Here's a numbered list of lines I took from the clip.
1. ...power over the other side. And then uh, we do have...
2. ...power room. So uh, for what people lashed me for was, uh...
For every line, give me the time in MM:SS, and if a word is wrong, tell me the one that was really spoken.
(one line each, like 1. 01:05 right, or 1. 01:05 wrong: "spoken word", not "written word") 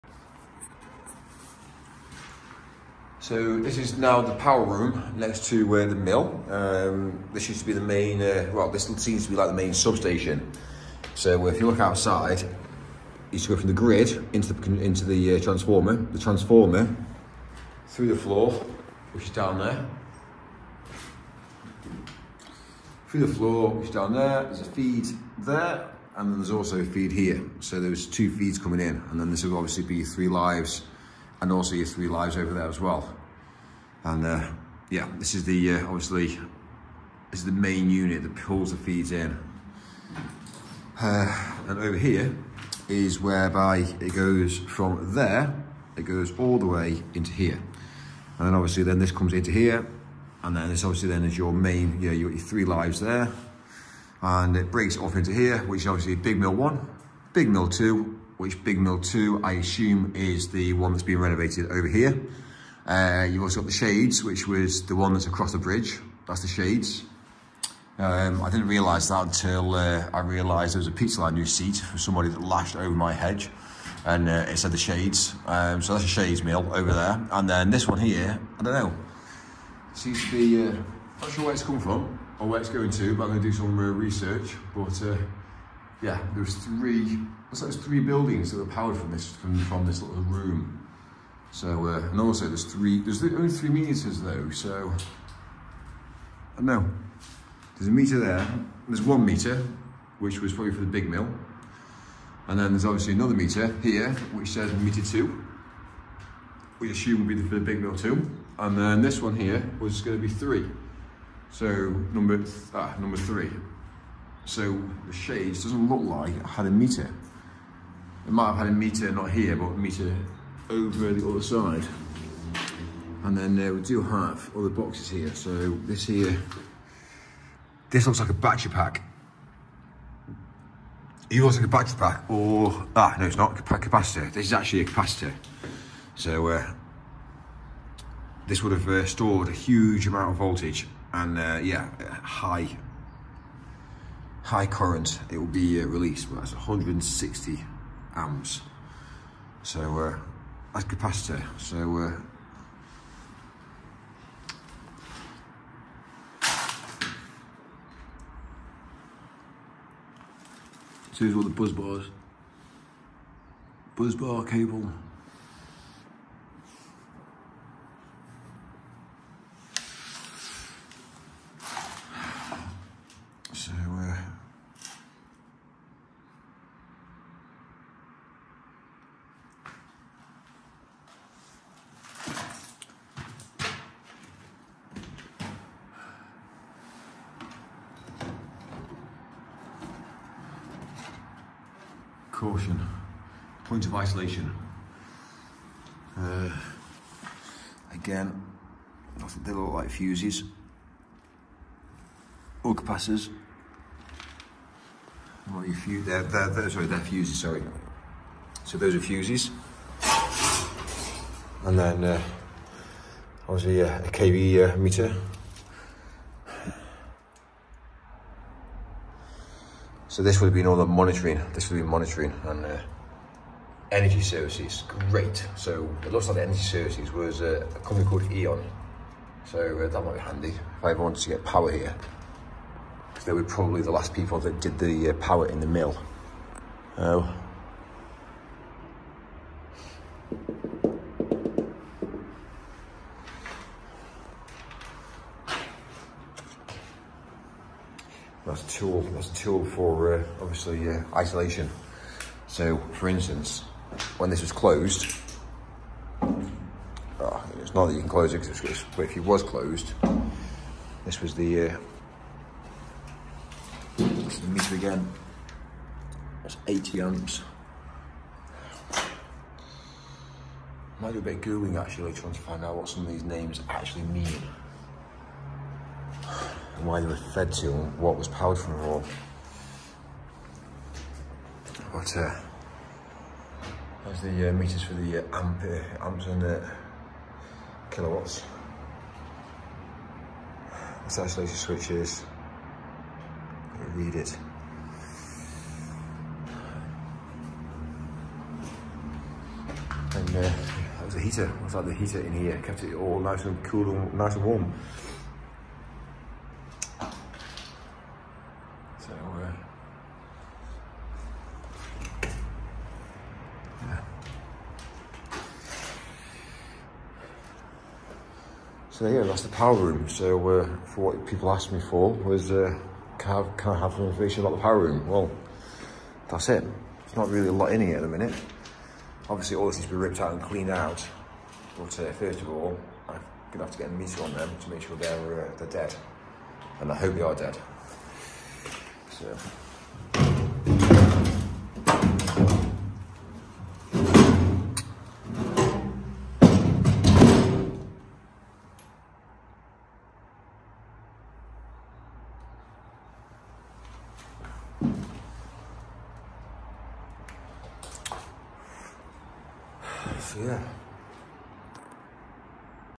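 1. 01:59 wrong: "meter", not "power"
2. 05:19 wrong: "asked", not "lashed".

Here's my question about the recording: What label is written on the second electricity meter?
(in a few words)
meter two.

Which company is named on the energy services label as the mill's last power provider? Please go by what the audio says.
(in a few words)
E.ON.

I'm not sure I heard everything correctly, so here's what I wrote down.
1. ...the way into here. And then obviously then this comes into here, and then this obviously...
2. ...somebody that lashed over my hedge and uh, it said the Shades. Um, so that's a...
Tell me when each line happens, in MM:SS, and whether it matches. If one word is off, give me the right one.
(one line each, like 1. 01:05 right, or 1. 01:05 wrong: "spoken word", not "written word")
1. 00:46 right
2. 01:11 right.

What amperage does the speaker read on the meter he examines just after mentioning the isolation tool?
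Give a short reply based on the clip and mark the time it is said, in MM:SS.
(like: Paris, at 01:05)
80 amps, at 04:26.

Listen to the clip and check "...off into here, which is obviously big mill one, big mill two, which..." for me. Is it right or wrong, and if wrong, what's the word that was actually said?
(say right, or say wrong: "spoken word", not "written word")
right.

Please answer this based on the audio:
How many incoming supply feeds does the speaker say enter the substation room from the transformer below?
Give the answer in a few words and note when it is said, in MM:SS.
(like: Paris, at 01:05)
2, at 00:28.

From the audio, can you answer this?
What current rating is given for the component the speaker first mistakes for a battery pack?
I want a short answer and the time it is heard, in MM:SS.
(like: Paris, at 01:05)
160 amps, at 02:26.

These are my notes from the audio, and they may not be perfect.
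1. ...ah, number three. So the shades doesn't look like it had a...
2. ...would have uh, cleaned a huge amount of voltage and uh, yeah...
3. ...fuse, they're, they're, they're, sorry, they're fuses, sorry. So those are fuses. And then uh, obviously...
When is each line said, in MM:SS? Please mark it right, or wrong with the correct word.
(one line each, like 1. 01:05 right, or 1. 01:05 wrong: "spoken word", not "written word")
1. 01:52 right
2. 02:18 wrong: "stored", not "cleaned"
3. 03:25 right.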